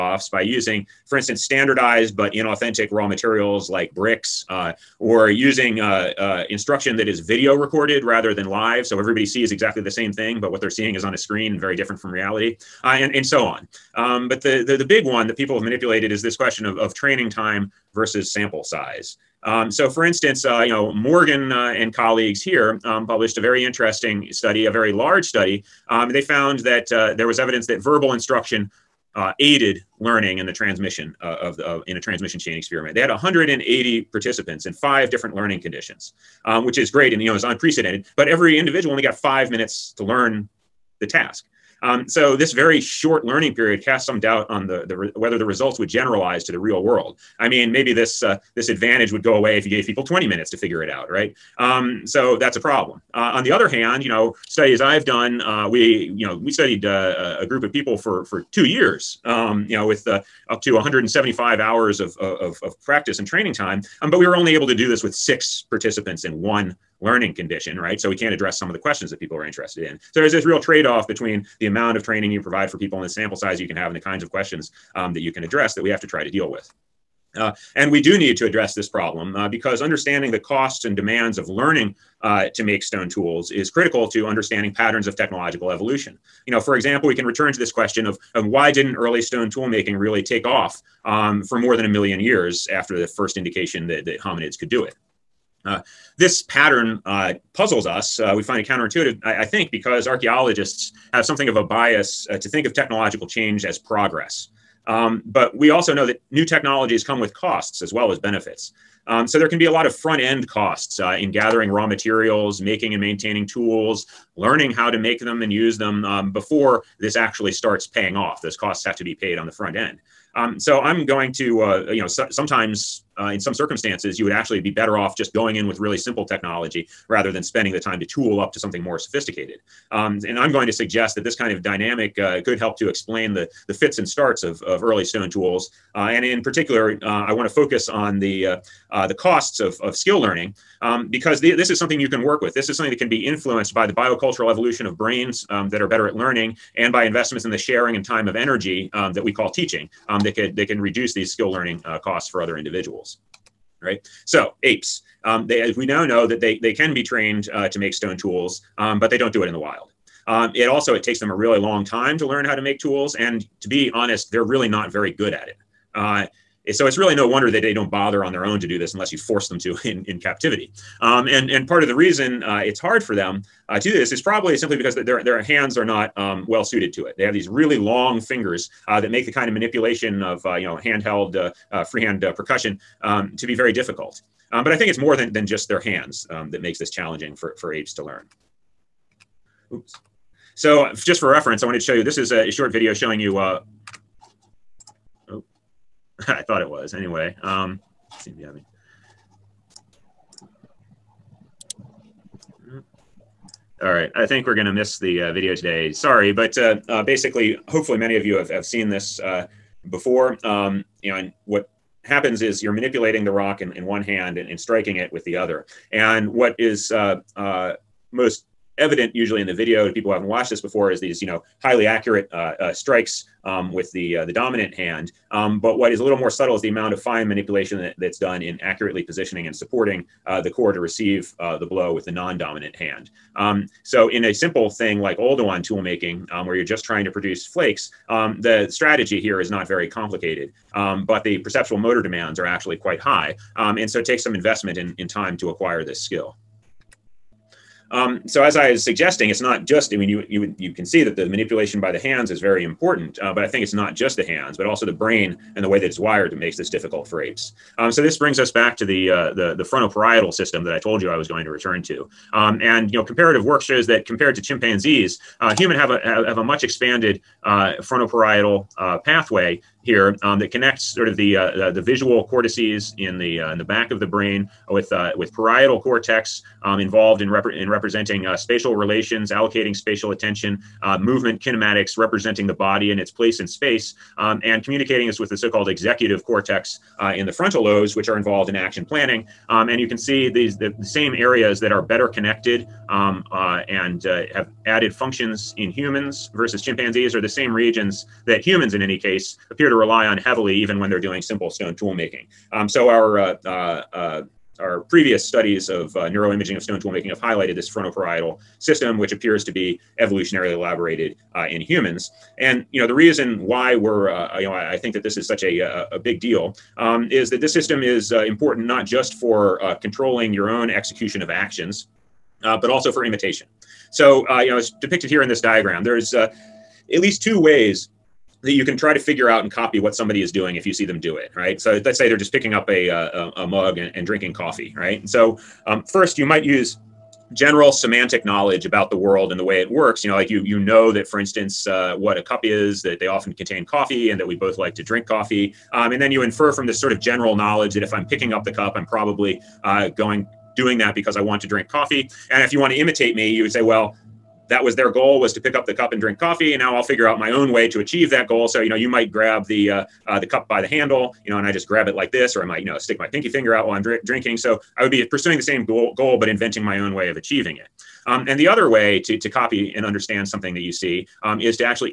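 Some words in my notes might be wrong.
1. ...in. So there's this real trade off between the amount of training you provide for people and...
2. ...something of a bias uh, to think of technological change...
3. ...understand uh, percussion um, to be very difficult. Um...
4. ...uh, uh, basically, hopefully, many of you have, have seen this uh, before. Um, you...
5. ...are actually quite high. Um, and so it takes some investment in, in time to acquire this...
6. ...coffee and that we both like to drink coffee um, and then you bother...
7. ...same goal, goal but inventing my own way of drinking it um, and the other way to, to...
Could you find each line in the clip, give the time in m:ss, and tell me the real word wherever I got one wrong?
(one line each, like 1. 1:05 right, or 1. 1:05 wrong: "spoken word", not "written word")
1. 1:09 right
2. 1:41 right
3. 3:01 wrong: "freehand", not "understand"
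4. 3:26 right
5. 4:02 right
6. 5:43 wrong: "infer", not "bother"
7. 6:05 wrong: "achieving", not "drinking".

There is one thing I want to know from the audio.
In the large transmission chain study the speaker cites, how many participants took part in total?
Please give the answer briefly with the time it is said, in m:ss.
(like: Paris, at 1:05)
180, at 0:33.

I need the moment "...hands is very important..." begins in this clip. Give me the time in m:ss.
4:11.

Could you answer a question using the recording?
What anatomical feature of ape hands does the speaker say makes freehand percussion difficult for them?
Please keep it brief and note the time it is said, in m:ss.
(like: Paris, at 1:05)
Really long fingers, at 2:57.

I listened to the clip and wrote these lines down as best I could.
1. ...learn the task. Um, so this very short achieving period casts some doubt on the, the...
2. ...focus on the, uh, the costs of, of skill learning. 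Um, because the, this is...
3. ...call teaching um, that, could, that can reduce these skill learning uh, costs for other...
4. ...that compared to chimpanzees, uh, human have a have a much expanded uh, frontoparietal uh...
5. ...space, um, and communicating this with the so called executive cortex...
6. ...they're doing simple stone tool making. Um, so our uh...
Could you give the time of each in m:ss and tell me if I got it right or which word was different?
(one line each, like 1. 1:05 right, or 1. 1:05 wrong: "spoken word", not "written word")
1. 0:40 wrong: "learning", not "achieving"
2. 2:17 right
3. 2:29 right
4. 4:23 right
5. 4:43 right
6. 5:00 right.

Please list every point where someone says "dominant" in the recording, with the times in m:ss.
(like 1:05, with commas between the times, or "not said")
3:44, 3:52.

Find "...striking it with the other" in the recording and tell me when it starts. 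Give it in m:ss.
3:34.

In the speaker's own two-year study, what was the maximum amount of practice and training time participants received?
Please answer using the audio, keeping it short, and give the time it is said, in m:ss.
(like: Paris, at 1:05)
175 hours, at 1:00.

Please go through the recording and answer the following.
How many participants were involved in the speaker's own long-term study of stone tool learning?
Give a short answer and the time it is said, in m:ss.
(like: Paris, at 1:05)
6, at 1:05.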